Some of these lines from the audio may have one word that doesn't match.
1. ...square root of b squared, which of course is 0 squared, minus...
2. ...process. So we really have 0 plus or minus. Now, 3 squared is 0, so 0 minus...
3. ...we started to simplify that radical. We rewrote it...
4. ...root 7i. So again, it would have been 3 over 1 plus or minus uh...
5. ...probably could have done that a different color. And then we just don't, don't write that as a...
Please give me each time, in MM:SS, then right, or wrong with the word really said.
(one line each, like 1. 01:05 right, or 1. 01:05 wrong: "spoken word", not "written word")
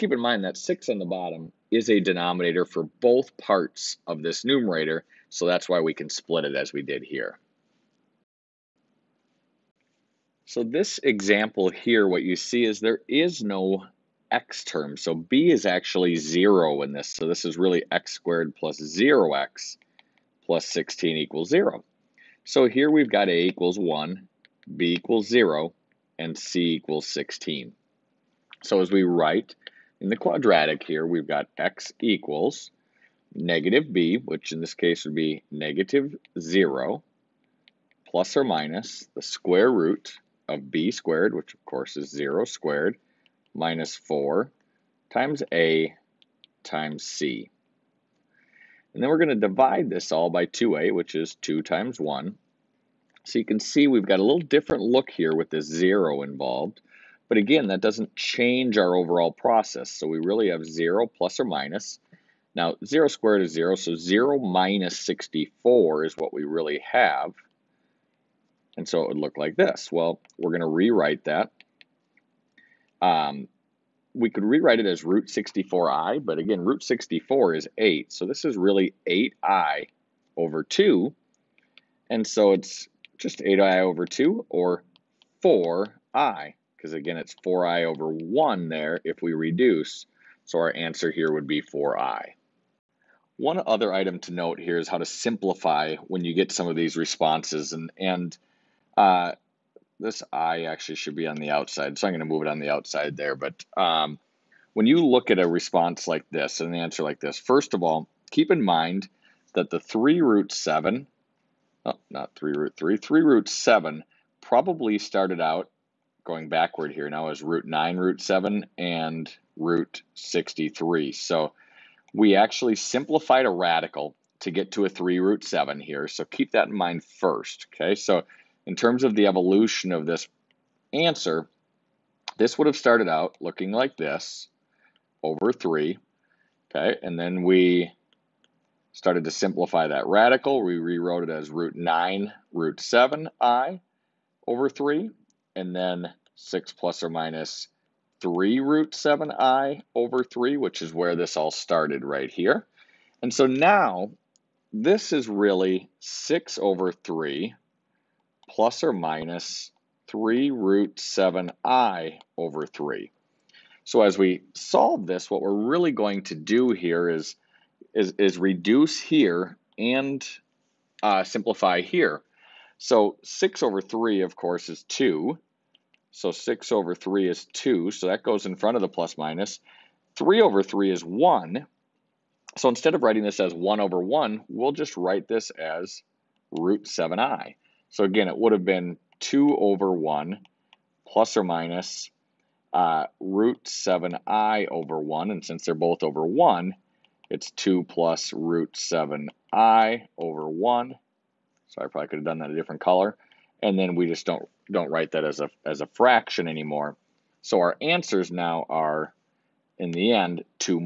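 1. 00:39 right
2. 00:59 wrong: "0", not "3"
3. 02:17 right
4. 03:06 wrong: "2", not "3"
5. 03:21 right.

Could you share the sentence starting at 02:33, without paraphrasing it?
And so now this is really 6 over 3 plus or minus 3 root 7i over 3.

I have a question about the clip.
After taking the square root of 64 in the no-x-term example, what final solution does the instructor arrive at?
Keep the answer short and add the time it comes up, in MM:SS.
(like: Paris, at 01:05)
4i, at 01:30.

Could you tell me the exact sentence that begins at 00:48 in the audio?
And then we're going to divide this all by 2a, which is 2 times 1.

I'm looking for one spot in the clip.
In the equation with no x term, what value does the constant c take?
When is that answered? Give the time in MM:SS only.
00:26.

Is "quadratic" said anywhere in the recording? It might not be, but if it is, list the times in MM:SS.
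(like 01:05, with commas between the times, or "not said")
00:30.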